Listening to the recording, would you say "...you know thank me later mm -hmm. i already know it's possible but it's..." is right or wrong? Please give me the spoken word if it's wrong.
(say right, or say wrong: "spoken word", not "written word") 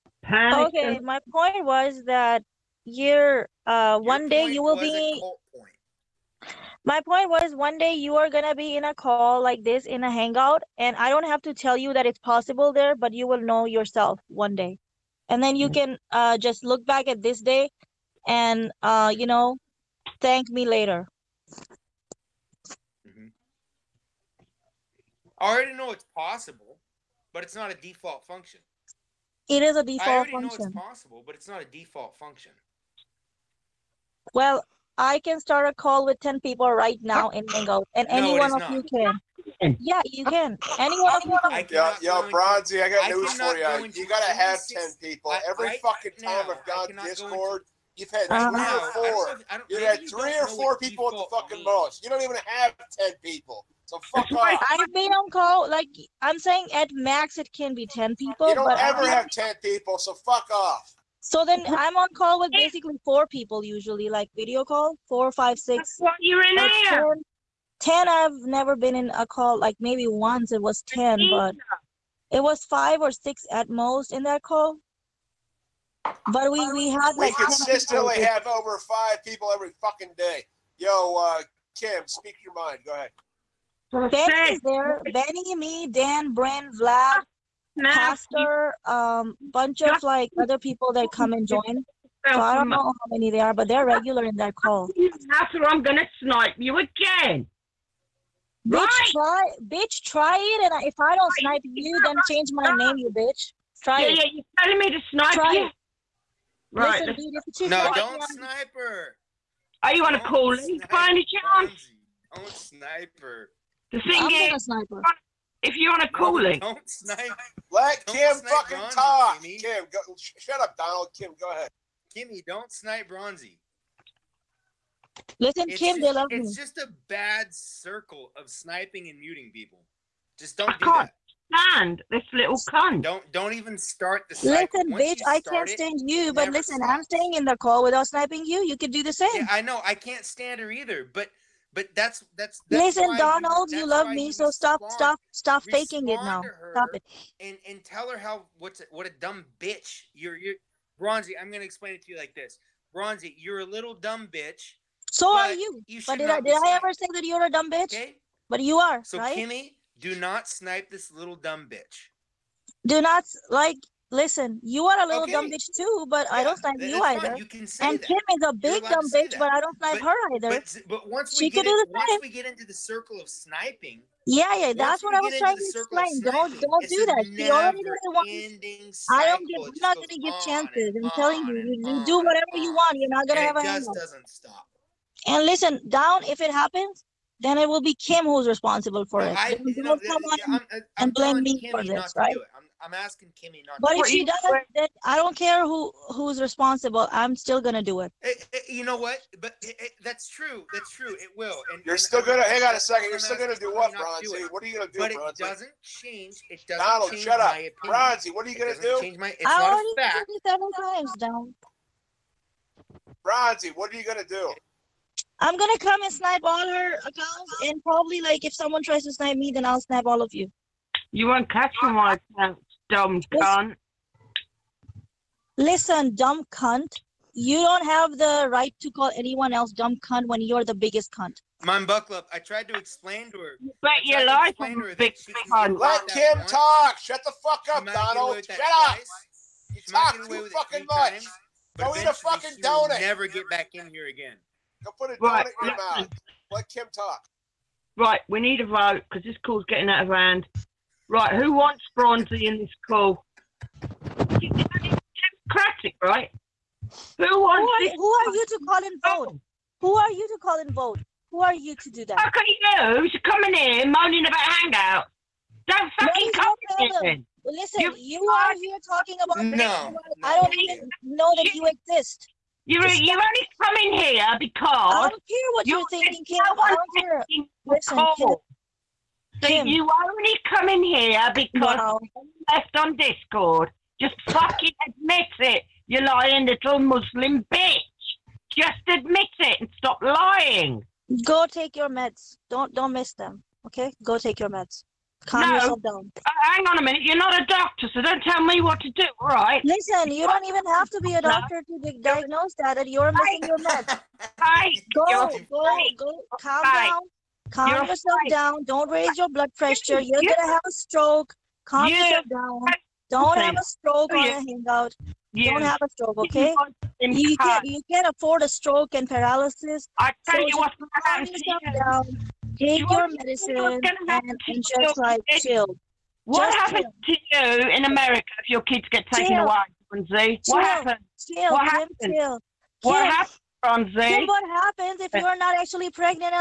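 right.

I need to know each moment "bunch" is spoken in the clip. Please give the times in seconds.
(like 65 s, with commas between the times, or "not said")
89 s.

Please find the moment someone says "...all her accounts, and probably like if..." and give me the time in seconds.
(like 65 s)
216 s.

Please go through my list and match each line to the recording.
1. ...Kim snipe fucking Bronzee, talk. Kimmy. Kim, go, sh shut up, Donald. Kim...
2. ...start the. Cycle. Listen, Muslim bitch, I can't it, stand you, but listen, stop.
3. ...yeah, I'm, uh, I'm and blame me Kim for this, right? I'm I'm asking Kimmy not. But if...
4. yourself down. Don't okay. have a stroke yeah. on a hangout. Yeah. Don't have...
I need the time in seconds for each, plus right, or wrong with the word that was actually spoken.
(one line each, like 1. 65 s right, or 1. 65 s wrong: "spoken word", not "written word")
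1. 118 s right
2. 133 s wrong: "Once", not "Muslim"
3. 190 s right
4. 312 s right.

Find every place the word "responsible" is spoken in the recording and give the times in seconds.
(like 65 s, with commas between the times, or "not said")
188 s, 196 s.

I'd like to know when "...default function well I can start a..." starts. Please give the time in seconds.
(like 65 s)
31 s.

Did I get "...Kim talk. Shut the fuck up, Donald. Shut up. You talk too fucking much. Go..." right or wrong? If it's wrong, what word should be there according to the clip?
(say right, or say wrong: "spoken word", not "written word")
right.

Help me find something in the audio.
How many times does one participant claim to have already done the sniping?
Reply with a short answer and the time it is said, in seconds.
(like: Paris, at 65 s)
7, at 210 s.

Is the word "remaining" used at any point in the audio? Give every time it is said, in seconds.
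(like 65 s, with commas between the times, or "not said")
not said.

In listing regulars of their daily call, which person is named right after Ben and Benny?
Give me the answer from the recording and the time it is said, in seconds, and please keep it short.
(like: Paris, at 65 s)
Dan, at 85 s.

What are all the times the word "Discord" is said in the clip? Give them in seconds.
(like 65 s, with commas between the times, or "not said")
47 s, 282 s.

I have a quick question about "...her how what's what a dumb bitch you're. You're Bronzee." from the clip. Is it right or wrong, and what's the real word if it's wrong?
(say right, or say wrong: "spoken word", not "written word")
right.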